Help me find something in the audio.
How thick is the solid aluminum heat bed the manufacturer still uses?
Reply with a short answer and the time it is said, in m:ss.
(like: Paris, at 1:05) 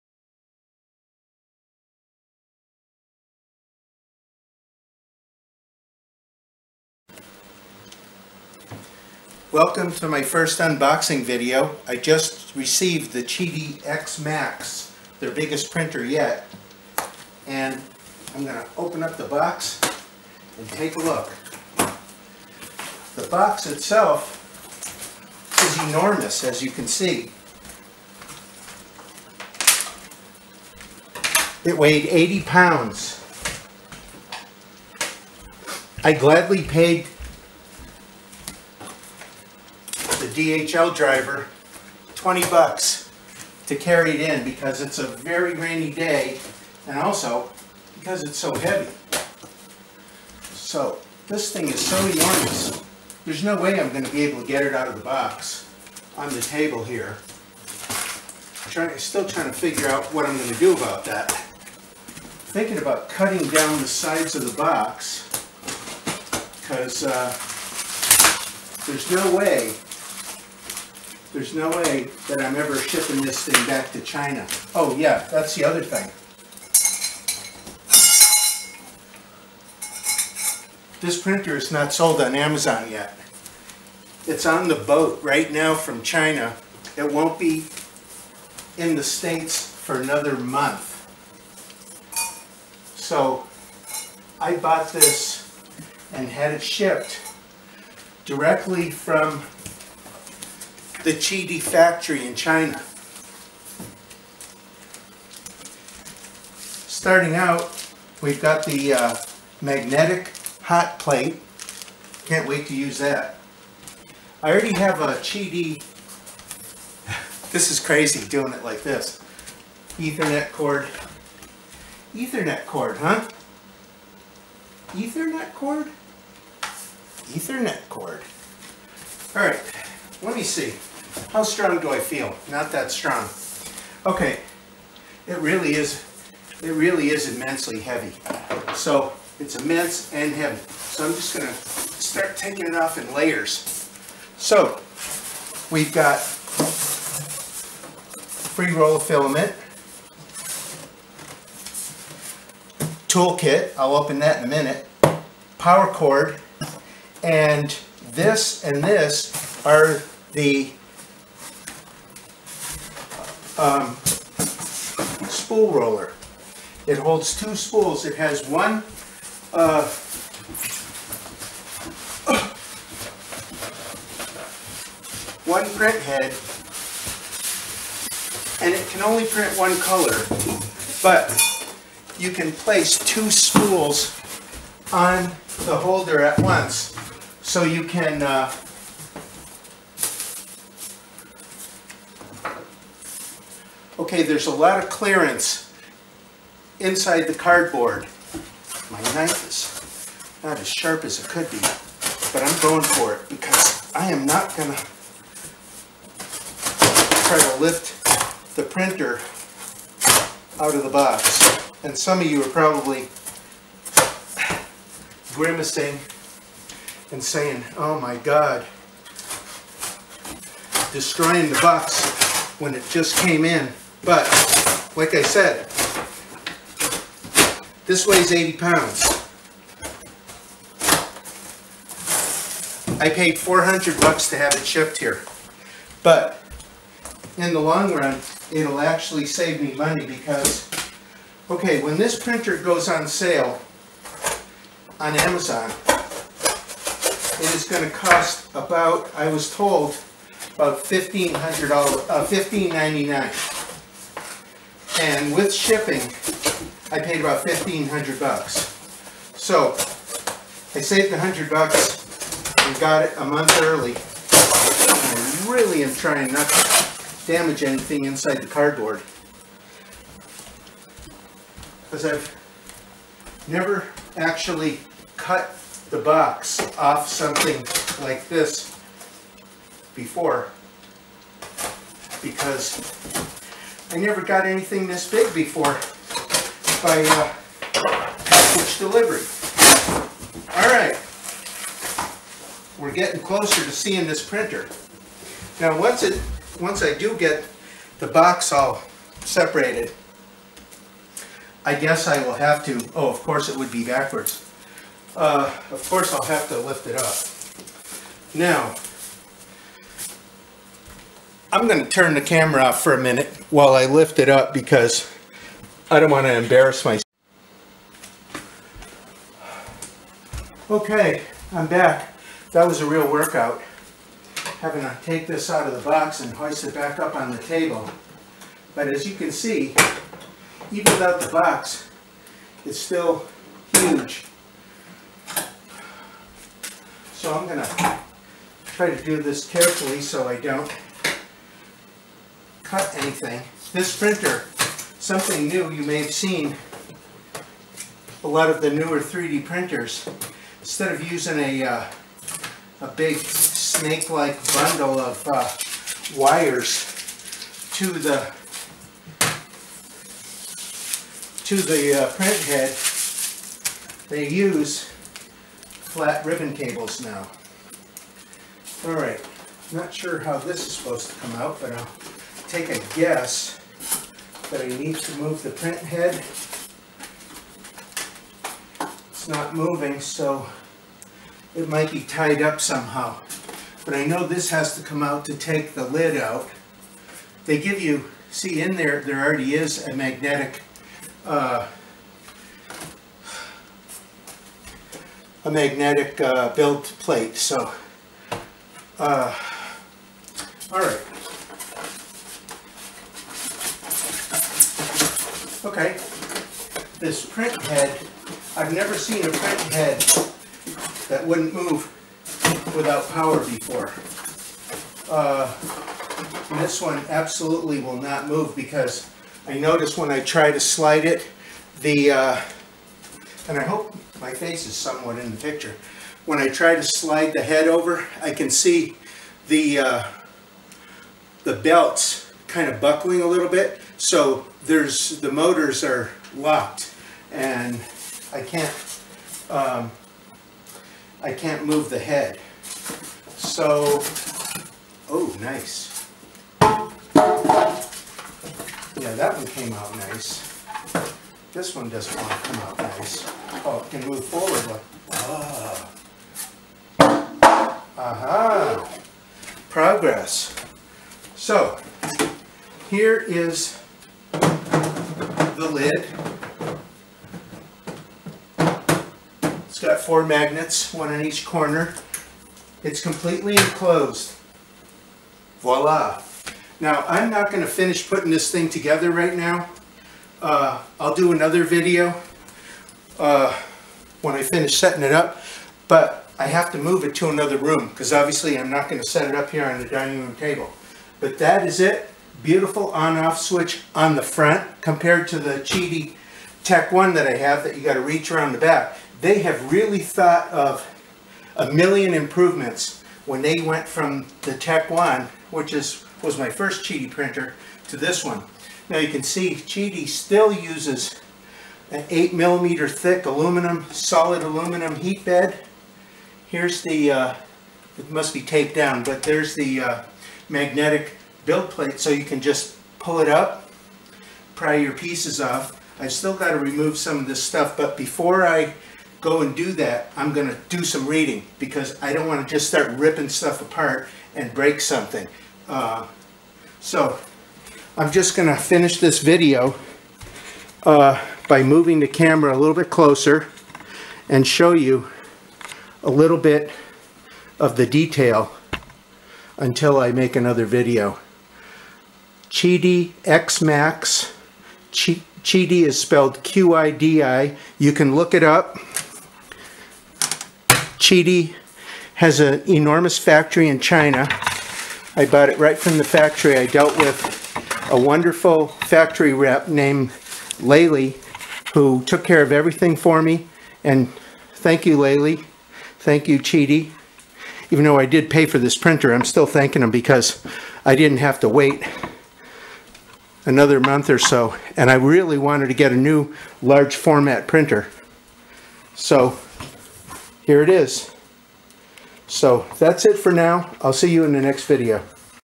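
8 millimeters, at 8:32.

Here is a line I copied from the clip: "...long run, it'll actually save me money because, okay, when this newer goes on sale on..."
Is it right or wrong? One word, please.
wrong.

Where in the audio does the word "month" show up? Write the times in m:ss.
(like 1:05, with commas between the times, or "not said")
1:30, 4:23, 9:43.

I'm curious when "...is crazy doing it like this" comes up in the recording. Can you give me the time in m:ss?
1:57.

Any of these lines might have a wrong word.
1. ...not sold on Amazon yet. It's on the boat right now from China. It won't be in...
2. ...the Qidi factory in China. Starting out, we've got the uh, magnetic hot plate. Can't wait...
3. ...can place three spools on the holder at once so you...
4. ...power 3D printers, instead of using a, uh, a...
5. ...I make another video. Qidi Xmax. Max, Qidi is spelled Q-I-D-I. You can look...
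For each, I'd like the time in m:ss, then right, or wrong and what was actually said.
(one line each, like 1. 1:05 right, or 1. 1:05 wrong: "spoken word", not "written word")
1. 1:21 right
2. 1:41 right
3. 3:02 wrong: "two", not "three"
4. 5:48 wrong: "newer", not "power"
5. 9:09 right.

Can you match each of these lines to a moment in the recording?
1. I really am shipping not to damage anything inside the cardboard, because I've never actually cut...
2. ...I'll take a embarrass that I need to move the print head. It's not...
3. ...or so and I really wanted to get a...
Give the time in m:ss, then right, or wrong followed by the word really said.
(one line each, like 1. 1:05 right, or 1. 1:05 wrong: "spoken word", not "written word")
1. 4:24 wrong: "trying", not "shipping"
2. 6:11 wrong: "guess", not "embarrass"
3. 9:44 right.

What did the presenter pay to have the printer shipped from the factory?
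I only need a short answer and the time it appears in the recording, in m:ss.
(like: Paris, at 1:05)
400 bucks, at 3:53.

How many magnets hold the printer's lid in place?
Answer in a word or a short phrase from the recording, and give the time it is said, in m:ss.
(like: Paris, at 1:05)
four, at 7:49.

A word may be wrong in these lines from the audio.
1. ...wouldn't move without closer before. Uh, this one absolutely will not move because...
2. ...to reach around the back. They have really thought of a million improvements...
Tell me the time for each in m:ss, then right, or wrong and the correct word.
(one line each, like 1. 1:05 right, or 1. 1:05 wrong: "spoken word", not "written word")
1. 6:51 wrong: "power", not "closer"
2. 8:17 right.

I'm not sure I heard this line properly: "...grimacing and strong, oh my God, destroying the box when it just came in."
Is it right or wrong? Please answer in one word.
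wrong.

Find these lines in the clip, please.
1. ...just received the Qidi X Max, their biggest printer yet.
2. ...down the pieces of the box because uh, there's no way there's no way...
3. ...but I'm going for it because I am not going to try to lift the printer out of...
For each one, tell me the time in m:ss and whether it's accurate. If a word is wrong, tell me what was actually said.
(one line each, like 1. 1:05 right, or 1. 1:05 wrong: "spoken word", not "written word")
1. 0:11 right
2. 1:03 wrong: "sides", not "pieces"
3. 3:22 right.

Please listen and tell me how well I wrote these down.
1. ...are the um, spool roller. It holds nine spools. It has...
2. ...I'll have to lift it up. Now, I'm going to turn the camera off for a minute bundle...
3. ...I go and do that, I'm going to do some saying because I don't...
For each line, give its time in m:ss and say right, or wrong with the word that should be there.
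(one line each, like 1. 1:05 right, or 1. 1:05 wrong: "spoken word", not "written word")
1. 2:39 wrong: "two", not "nine"
2. 5:06 wrong: "while", not "bundle"
3. 8:48 wrong: "reading", not "saying".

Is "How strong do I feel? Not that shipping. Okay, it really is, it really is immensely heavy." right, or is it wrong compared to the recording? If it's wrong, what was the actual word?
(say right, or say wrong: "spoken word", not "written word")
wrong: "strong", not "shipping".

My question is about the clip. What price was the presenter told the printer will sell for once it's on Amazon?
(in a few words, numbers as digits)
$1,599.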